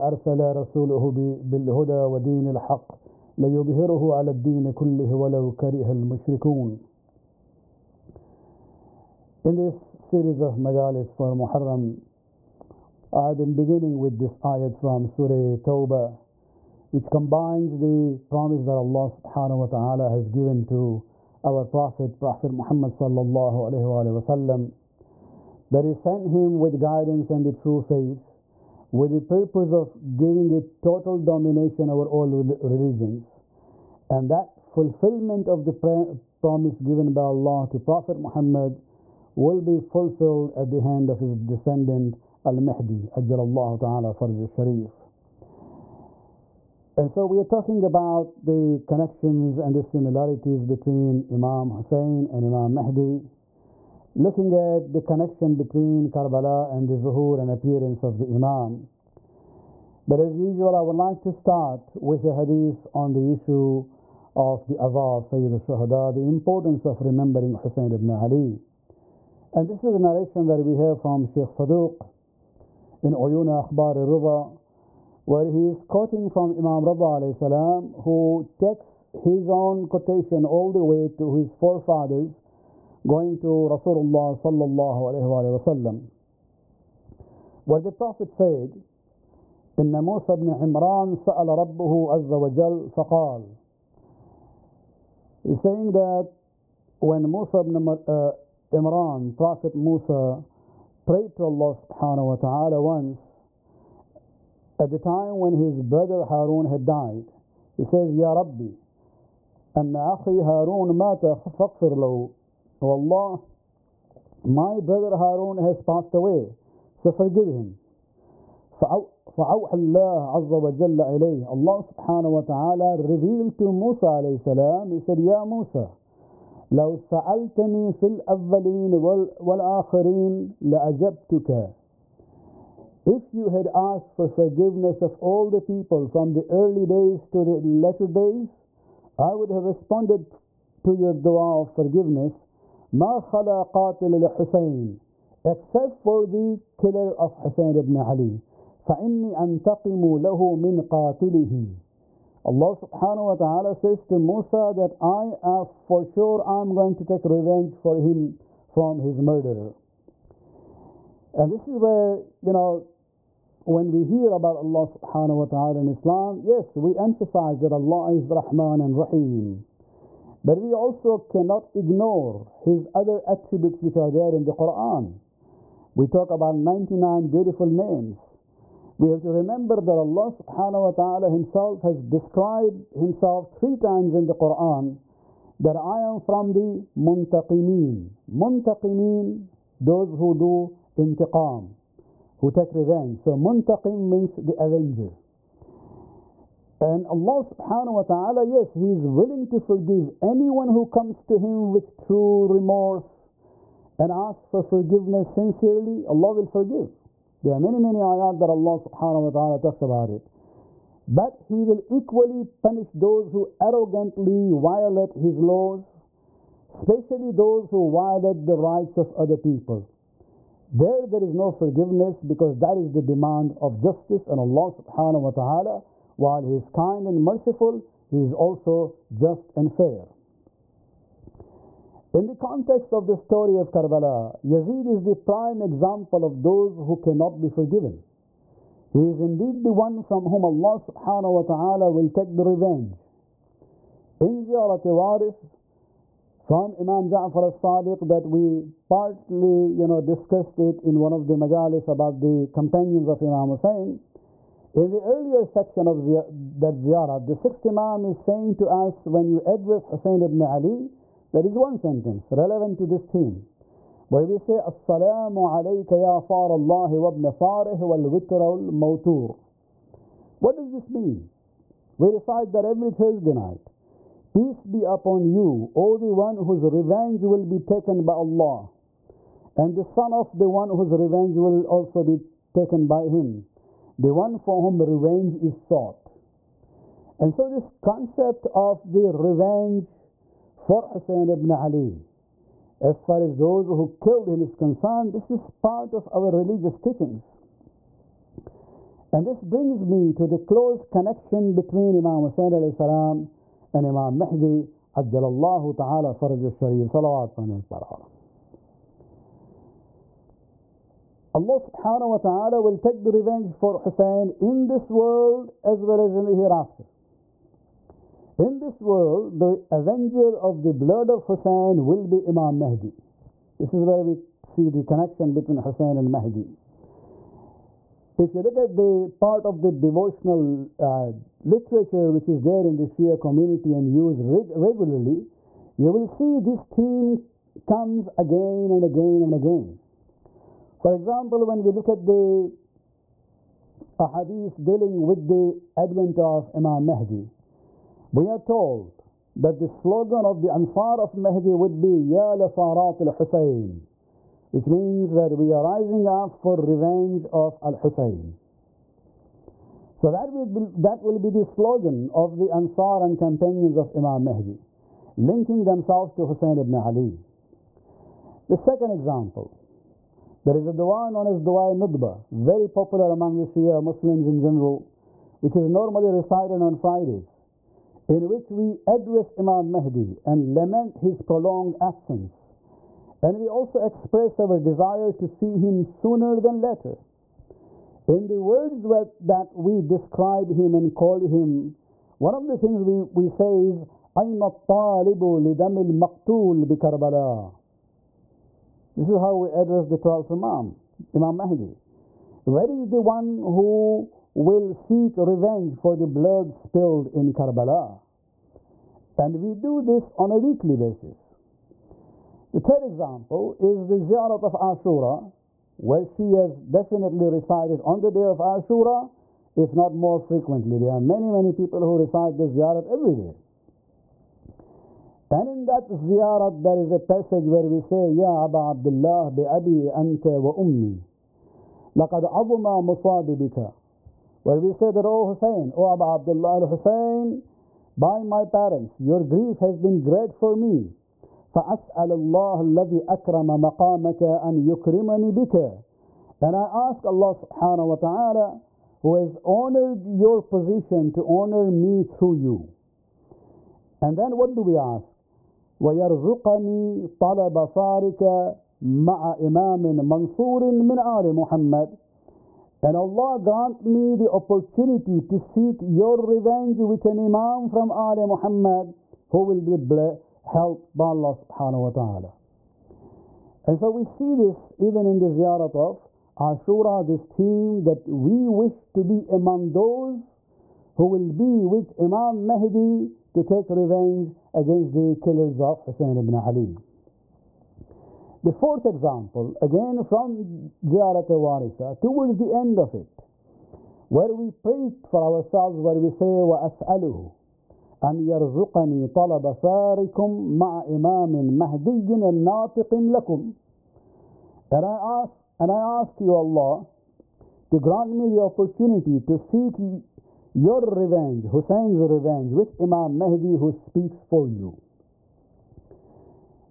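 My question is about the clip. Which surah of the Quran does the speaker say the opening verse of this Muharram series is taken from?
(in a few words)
Surah Tawbah.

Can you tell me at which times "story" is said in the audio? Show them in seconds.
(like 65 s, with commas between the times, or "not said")
233 s.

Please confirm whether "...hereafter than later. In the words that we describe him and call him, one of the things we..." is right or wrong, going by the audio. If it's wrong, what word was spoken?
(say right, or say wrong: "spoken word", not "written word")
wrong: "sooner", not "hereafter".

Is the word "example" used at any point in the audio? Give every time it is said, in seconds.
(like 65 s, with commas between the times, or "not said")
235 s, 340 s, 368 s, 412 s, 488 s.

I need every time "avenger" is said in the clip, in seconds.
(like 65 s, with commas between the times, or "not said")
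194 s, 319 s.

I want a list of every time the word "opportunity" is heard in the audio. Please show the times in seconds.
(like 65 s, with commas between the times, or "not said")
464 s, 508 s.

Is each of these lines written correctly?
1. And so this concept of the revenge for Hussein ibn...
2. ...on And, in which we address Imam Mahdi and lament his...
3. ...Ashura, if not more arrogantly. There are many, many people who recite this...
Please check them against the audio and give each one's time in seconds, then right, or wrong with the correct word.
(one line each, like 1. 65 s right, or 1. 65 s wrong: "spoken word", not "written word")
1. 287 s right
2. 376 s wrong: "Fridays", not "And"
3. 418 s wrong: "frequently", not "arrogantly".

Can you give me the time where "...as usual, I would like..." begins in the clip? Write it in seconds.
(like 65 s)
60 s.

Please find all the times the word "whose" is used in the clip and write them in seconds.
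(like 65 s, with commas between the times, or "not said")
276 s, 280 s.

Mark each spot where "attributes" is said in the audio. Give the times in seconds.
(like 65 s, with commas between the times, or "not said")
173 s.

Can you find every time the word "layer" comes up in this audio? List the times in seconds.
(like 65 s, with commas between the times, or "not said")
not said.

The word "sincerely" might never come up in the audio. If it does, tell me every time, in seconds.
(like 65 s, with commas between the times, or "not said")
205 s.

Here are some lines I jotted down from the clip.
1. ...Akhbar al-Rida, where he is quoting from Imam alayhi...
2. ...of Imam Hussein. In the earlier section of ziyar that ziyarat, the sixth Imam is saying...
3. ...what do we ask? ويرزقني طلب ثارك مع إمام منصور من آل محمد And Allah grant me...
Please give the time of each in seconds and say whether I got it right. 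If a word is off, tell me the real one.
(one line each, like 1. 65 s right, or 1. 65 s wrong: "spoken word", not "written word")
1. 73 s right
2. 253 s right
3. 454 s right.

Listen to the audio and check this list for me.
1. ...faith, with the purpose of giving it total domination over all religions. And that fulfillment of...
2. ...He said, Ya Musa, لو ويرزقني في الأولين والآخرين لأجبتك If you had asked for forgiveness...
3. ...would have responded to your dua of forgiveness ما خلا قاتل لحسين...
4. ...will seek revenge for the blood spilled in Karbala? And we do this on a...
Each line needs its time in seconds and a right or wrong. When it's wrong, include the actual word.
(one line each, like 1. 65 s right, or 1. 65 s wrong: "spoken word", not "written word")
1. 27 s right
2. 124 s wrong: "سألتني", not "ويرزقني"
3. 139 s right
4. 404 s right.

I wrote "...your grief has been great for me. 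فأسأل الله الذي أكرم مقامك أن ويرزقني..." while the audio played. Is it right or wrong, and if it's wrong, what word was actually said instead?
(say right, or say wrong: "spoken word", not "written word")
wrong: "يكرمني", not "ويرزقني".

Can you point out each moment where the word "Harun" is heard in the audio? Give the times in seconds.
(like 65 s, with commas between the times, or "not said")
106 s, 110 s, 115 s.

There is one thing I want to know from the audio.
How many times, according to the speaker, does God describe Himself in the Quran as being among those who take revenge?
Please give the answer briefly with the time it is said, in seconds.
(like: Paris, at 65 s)
3, at 183 s.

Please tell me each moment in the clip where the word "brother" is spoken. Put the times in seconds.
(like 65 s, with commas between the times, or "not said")
105 s, 114 s.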